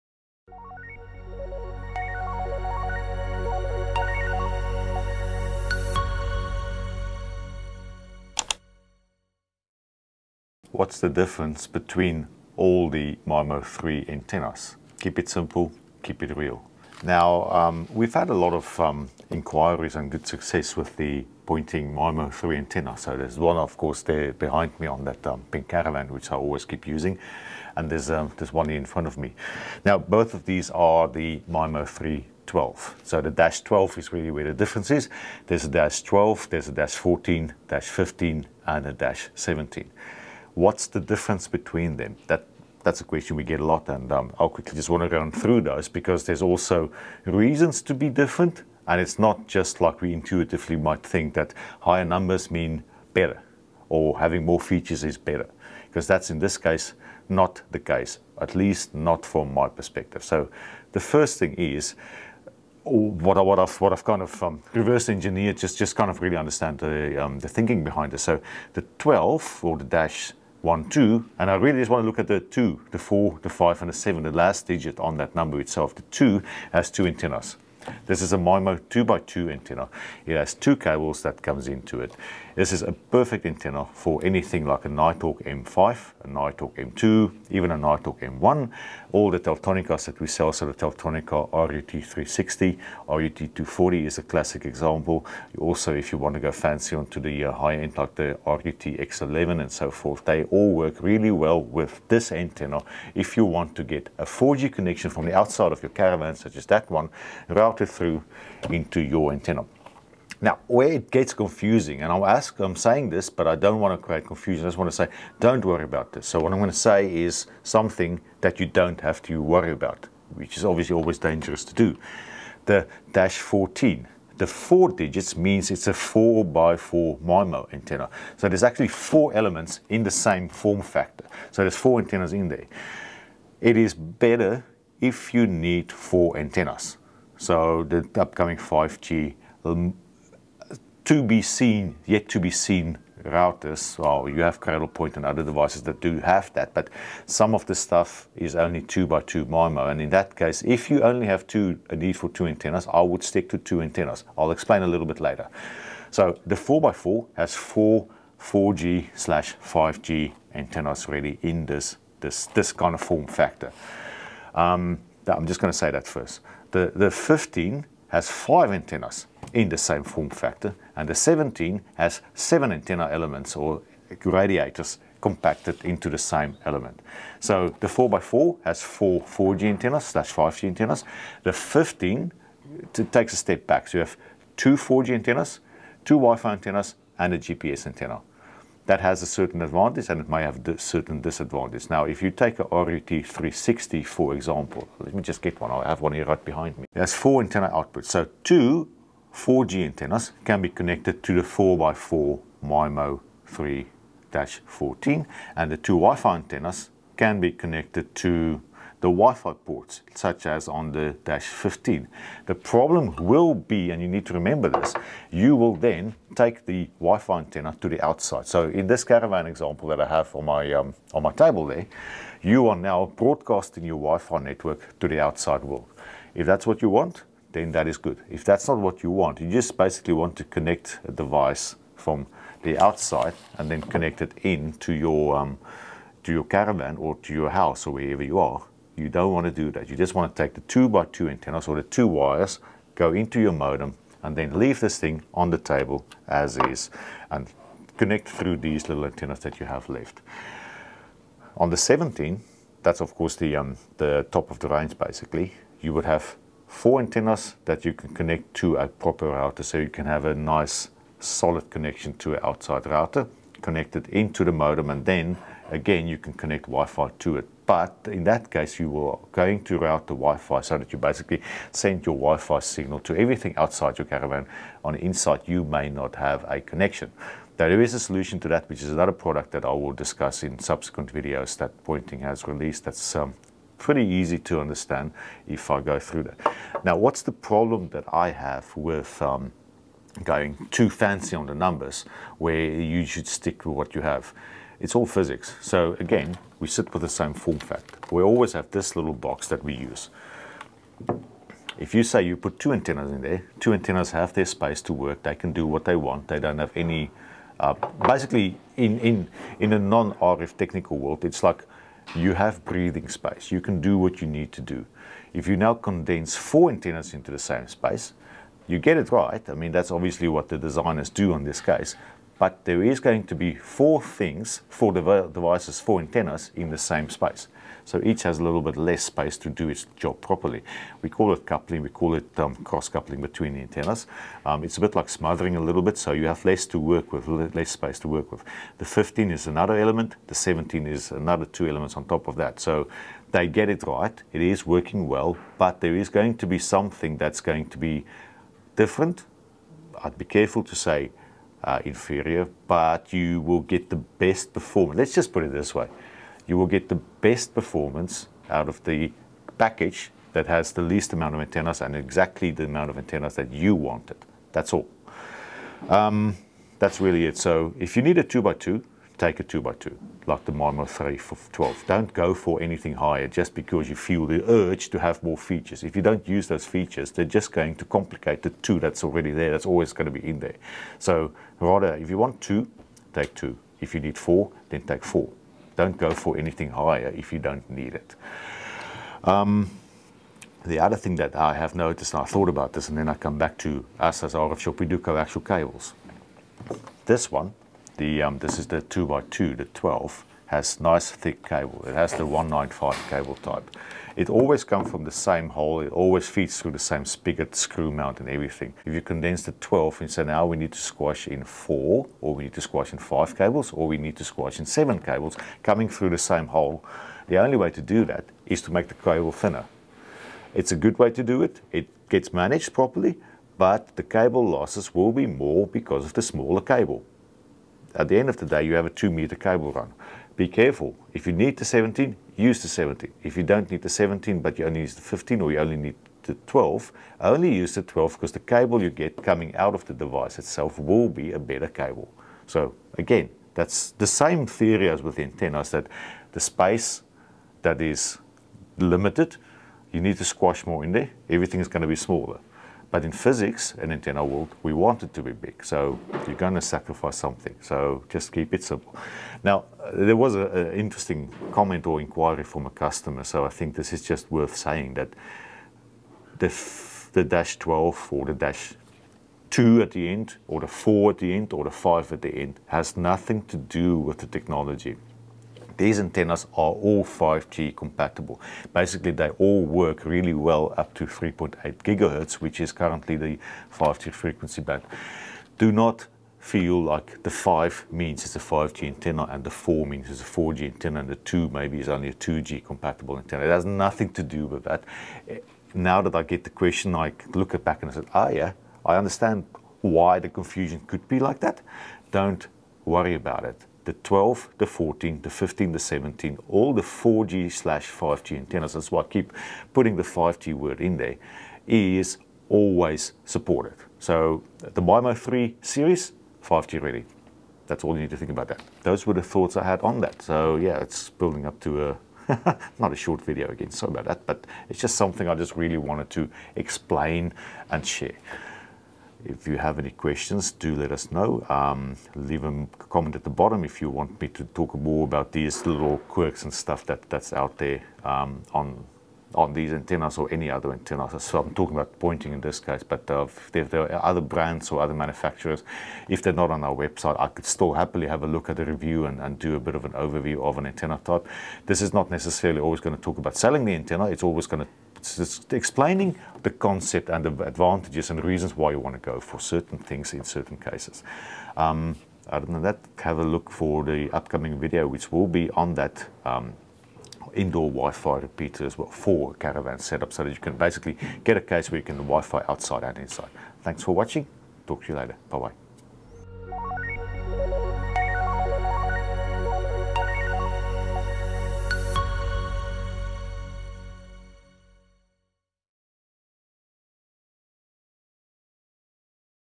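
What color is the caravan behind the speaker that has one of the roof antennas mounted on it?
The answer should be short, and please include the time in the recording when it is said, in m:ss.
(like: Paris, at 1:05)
Pink, at 0:25.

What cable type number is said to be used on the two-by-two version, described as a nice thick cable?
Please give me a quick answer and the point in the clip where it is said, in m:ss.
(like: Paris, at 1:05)
195, at 6:42.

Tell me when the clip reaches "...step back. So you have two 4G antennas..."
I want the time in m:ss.
3:03.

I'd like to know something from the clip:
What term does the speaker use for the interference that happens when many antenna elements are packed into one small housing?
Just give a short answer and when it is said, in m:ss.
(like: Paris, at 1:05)
Cross-coupling, at 5:32.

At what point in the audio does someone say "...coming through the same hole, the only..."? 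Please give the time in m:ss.
6:55.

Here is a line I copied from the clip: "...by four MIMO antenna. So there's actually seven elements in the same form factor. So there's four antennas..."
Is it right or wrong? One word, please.
wrong.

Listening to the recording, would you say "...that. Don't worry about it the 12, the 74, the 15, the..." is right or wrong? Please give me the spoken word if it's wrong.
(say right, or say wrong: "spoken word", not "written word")
wrong: "14", not "74".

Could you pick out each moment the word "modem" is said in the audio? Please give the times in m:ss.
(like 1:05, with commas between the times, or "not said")
4:03, 4:24.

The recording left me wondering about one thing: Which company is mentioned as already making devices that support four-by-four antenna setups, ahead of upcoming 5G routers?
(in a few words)
Cradlepoint.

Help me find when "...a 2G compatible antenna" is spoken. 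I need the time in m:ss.
8:12.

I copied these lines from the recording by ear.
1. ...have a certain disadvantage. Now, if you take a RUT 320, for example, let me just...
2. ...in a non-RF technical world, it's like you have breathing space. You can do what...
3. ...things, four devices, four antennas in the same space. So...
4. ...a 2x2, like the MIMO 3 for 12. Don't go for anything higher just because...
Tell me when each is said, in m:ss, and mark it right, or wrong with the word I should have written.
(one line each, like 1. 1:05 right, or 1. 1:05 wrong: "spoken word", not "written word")
1. 3:10 wrong: "360", not "320"
2. 5:09 right
3. 5:24 right
4. 6:09 right.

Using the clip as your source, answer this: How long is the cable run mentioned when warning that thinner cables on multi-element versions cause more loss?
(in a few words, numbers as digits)
2 meters.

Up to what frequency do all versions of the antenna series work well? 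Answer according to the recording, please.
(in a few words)
3.8 gigahertz.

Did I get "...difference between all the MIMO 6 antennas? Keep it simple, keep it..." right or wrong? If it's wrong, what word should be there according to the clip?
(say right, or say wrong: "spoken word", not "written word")
wrong: "3", not "6".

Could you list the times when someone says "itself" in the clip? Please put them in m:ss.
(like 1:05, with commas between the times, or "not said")
1:15, 7:20.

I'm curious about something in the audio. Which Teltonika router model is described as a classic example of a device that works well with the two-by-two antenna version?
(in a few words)
RUT240.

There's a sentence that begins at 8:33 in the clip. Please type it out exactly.
So the MIMO 3 series, 5G ready.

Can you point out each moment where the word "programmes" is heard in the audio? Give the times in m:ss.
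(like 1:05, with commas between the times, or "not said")
not said.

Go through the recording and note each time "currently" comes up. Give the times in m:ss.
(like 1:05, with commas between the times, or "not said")
8:02.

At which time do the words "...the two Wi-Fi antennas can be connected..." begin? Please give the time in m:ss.
3:25.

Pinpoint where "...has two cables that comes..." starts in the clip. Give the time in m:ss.
1:20.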